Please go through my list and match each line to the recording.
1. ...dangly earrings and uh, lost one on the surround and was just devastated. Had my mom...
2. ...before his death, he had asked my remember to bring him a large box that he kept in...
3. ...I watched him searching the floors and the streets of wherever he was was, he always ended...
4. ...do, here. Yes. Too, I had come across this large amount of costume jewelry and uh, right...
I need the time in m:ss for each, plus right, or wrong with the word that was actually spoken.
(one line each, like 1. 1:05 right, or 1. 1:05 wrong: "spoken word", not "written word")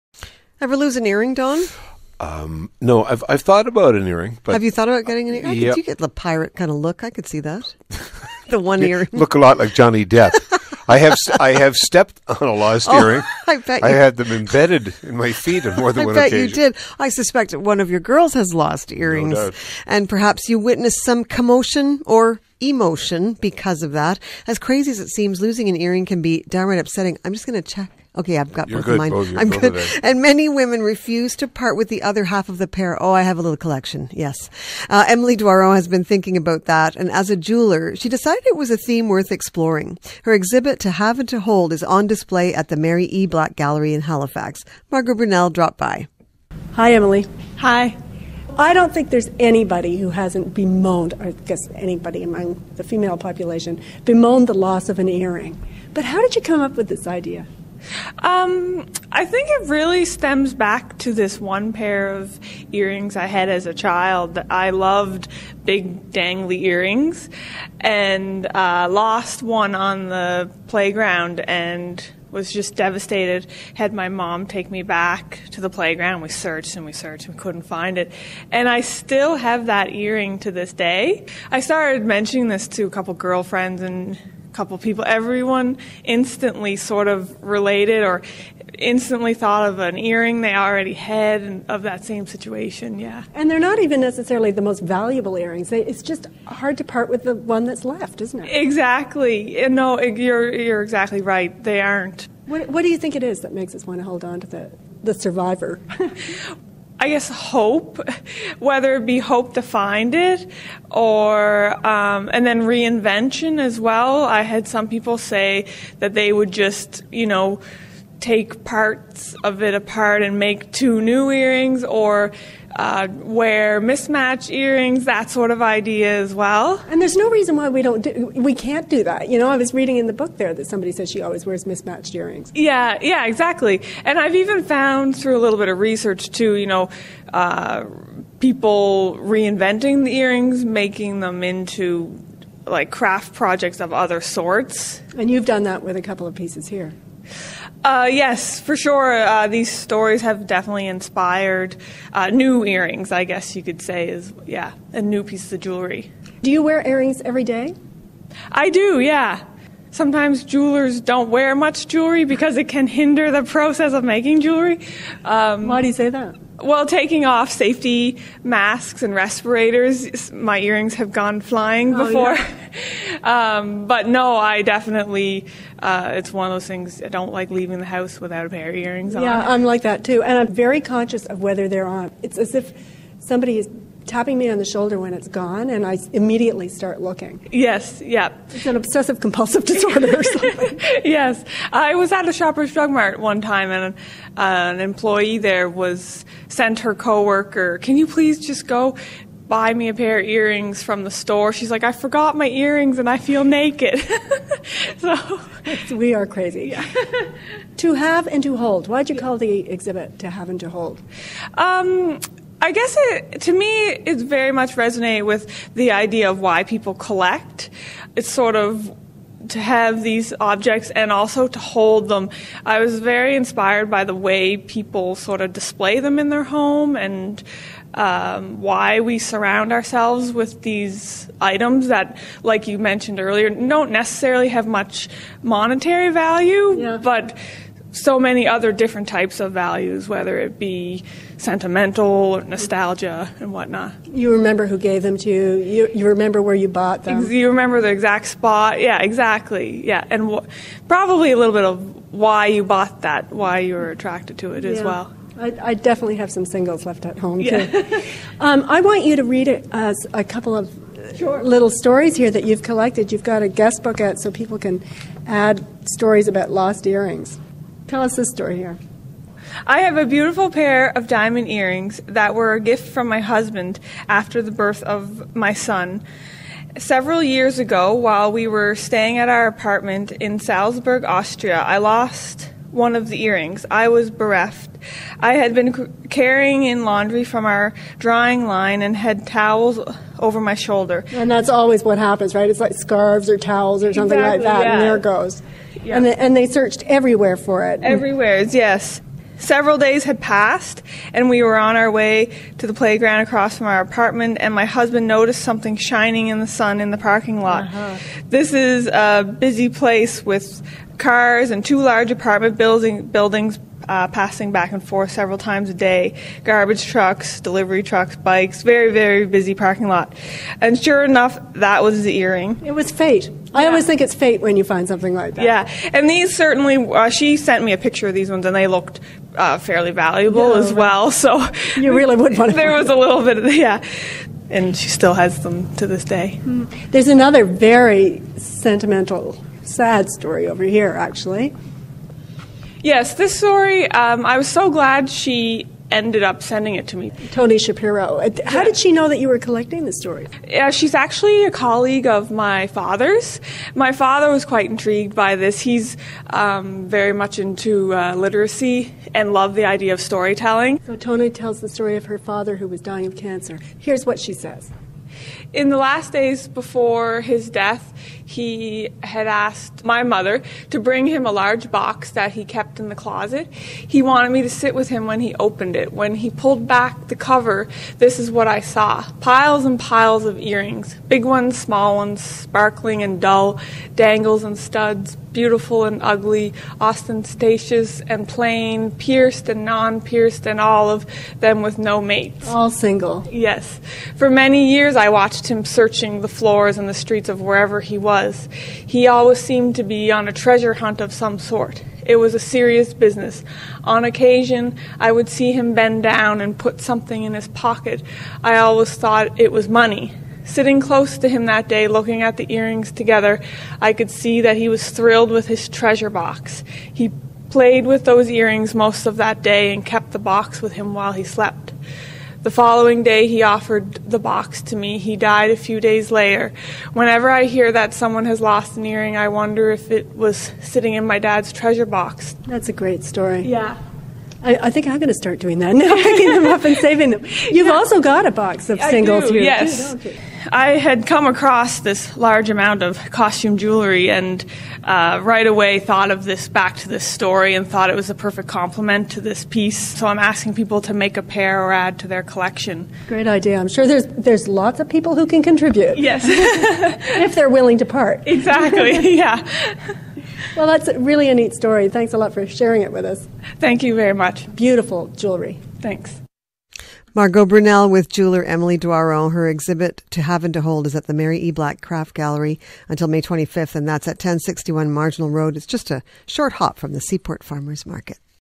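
1. 1:06 wrong: "playground", not "surround"
2. 6:06 wrong: "mother", not "remember"
3. 6:34 wrong: "seemed", not "ended"
4. 7:19 right.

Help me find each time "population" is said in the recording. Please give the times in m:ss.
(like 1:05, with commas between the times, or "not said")
0:53.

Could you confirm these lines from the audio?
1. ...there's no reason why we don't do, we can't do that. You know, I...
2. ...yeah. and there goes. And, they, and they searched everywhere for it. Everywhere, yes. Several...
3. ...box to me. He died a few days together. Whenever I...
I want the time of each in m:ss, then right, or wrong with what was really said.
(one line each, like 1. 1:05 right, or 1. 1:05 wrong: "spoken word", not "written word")
1. 2:07 right
2. 4:54 right
3. 7:04 wrong: "later", not "together".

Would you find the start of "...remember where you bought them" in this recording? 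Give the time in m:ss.
4:06.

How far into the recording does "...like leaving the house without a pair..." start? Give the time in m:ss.
2:57.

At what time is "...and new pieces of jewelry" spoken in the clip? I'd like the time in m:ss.
2:34.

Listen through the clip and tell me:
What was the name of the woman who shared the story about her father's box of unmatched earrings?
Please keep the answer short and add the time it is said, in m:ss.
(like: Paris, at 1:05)
Tony Shapiro, at 5:47.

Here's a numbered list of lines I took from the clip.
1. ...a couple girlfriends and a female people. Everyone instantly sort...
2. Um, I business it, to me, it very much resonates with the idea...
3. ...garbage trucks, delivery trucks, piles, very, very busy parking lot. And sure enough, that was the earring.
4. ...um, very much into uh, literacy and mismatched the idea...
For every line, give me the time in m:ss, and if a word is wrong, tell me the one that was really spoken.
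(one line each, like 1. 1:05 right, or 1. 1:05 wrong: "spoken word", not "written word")
1. 1:22 wrong: "couple", not "female"
2. 3:31 wrong: "guess", not "business"
3. 5:16 wrong: "bikes", not "piles"
4. 5:56 wrong: "loved", not "mismatched".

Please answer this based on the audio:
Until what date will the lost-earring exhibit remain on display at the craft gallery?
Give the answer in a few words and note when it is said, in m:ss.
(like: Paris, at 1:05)
May 25, at 7:53.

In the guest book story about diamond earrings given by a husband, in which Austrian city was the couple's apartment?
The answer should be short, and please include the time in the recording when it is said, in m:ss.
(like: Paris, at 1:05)
Salzburg, at 4:40.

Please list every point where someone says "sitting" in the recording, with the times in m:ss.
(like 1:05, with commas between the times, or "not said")
6:50, 7:10.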